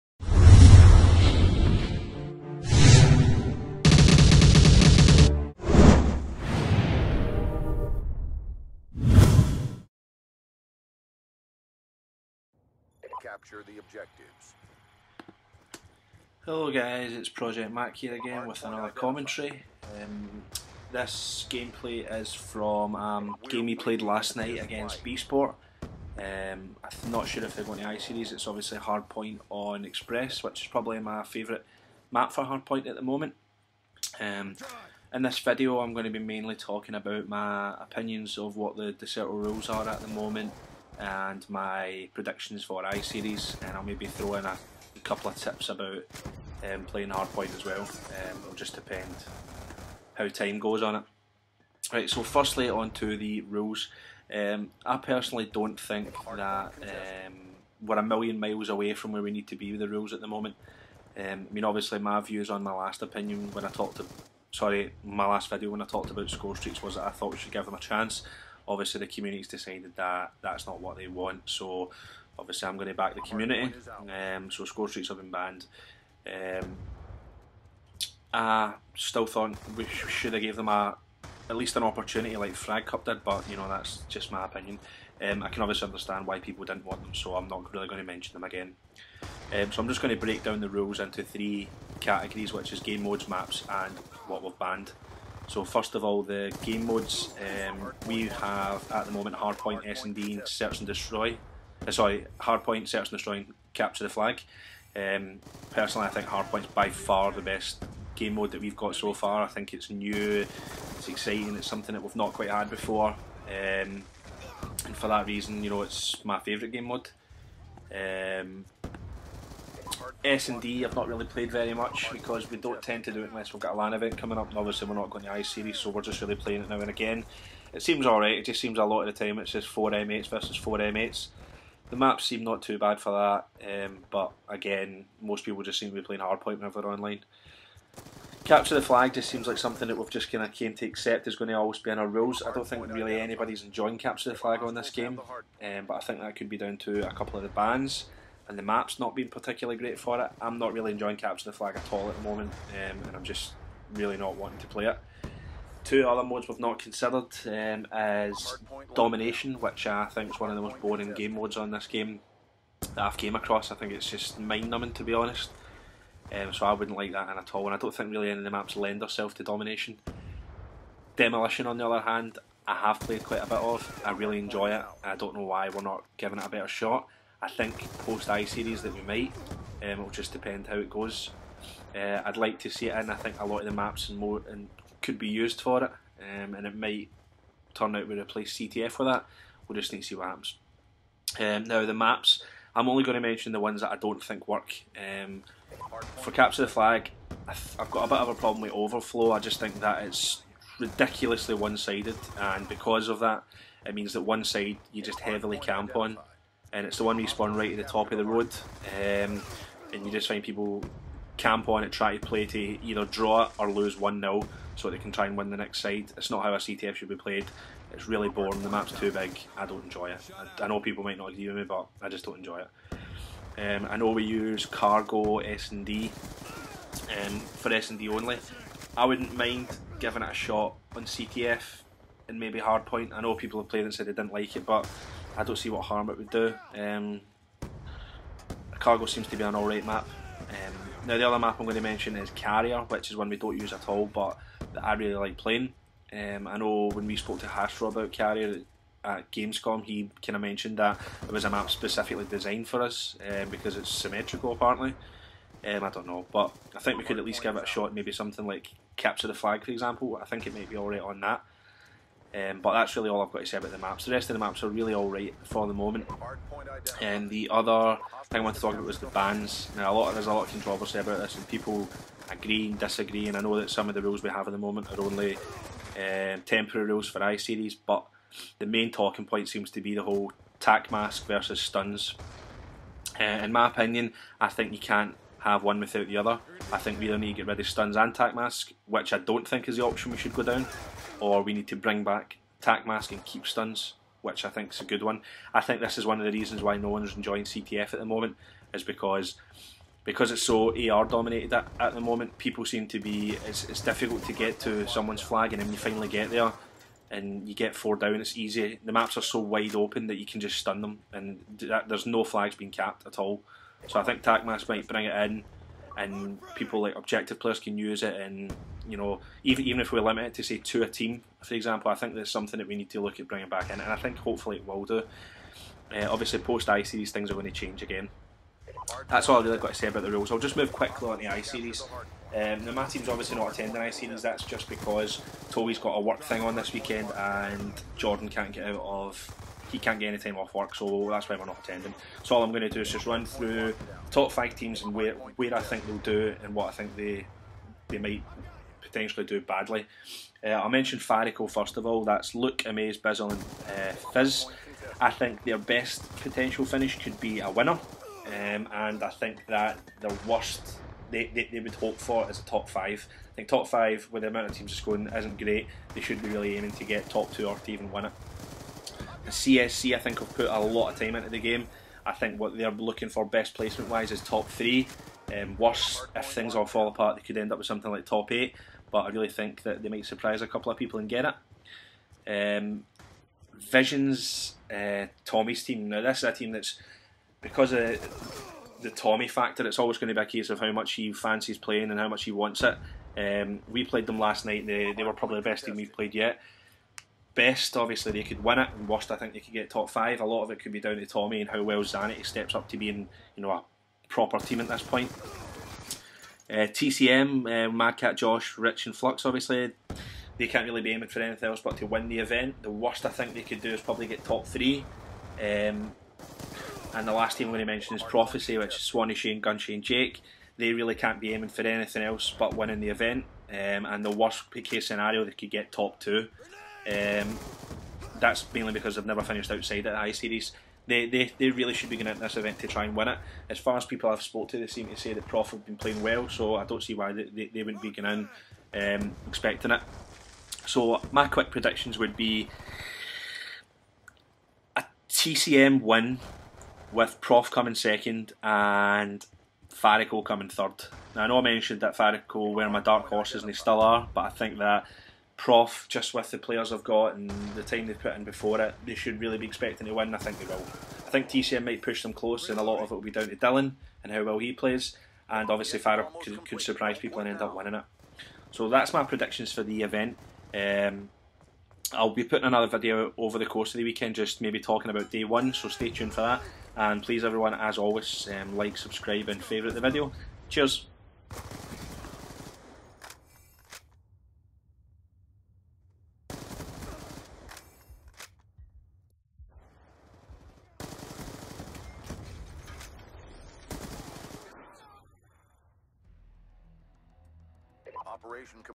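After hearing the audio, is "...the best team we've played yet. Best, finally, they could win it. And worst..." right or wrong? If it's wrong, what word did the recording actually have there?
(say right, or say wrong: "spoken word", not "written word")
wrong: "obviously", not "finally".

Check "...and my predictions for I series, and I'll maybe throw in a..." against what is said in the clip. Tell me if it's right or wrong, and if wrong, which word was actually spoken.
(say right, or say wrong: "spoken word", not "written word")
right.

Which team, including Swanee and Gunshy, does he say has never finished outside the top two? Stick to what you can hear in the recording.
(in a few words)
Prophecy.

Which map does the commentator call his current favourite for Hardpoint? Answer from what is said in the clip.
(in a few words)
Express.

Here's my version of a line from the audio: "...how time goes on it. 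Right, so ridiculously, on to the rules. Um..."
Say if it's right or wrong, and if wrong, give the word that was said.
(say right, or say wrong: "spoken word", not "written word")
wrong: "firstly", not "ridiculously".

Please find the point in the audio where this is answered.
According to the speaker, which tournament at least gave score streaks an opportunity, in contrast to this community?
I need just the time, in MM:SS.
01:22.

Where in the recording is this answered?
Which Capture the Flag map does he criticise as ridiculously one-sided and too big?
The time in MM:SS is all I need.
03:18.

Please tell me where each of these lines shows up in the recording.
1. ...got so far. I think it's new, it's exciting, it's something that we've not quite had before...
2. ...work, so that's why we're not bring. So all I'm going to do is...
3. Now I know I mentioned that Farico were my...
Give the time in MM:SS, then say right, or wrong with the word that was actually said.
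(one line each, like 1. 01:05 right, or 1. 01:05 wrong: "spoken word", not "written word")
1. 01:48 right
2. 05:40 wrong: "attending", not "bring"
3. 07:31 right.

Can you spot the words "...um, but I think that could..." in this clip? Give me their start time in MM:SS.
02:25.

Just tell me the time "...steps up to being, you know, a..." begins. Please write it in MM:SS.
06:42.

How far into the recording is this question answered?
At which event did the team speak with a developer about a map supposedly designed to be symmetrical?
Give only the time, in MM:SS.
04:09.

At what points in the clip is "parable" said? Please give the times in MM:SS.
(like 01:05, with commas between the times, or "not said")
not said.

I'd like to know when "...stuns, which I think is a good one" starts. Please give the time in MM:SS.
04:53.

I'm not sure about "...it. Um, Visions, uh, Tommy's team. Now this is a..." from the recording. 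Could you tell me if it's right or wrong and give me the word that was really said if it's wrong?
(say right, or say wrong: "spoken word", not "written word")
right.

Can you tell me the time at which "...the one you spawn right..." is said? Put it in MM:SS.
03:26.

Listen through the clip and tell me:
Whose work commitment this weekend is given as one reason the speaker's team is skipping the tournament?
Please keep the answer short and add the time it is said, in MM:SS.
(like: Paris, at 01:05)
Toby, at 05:35.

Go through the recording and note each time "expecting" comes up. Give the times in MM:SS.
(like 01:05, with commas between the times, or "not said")
07:19, 07:39.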